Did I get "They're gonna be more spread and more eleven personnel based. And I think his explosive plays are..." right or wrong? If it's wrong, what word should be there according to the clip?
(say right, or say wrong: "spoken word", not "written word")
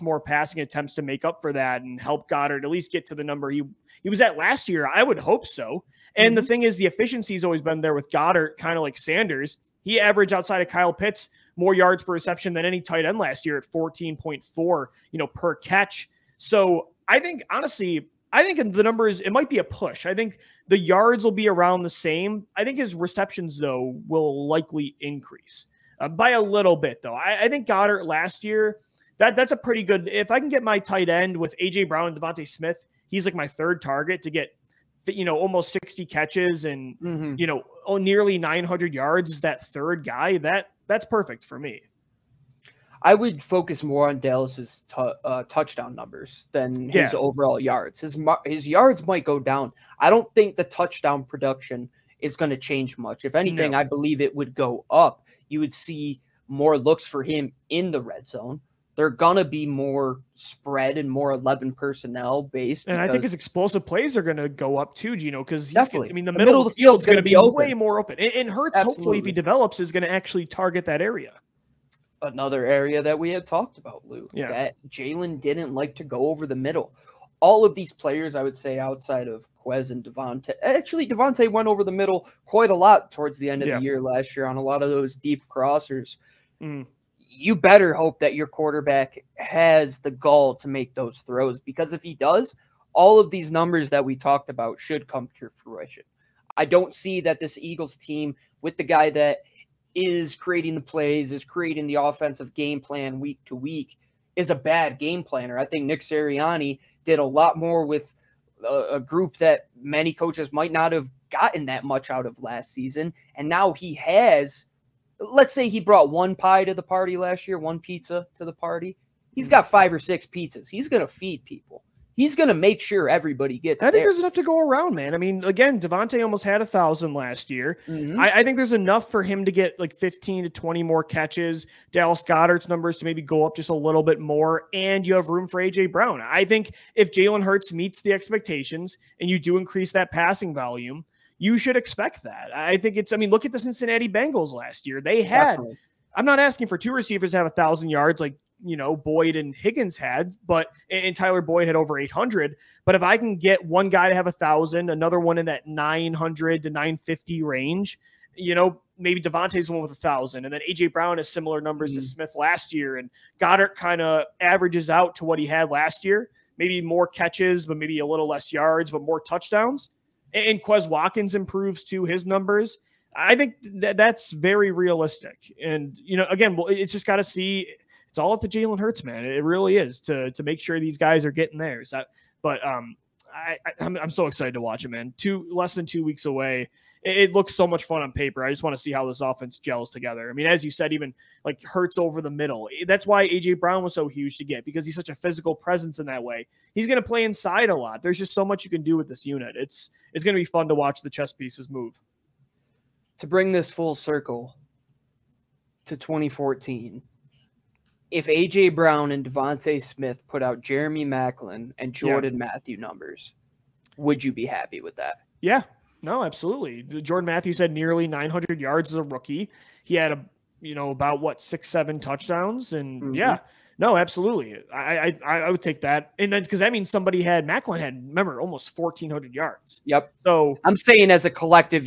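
right.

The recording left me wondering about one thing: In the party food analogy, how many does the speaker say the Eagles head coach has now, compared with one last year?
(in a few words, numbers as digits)
five or six.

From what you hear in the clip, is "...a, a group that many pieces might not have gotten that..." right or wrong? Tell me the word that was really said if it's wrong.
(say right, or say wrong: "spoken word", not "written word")
wrong: "coaches", not "pieces".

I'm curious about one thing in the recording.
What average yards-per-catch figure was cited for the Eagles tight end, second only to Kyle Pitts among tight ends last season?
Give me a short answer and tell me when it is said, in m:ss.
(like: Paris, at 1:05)
14.4, at 0:13.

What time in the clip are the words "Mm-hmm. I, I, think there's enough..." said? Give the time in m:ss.
2:07.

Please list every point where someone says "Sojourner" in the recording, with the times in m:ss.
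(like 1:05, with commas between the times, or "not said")
not said.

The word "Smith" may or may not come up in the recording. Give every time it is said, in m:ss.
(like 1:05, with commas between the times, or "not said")
0:32, 2:42, 3:29.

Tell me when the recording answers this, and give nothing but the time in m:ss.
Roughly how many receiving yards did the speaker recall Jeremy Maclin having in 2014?
3:48.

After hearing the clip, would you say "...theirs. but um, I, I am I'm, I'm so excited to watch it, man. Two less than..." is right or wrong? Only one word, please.
right.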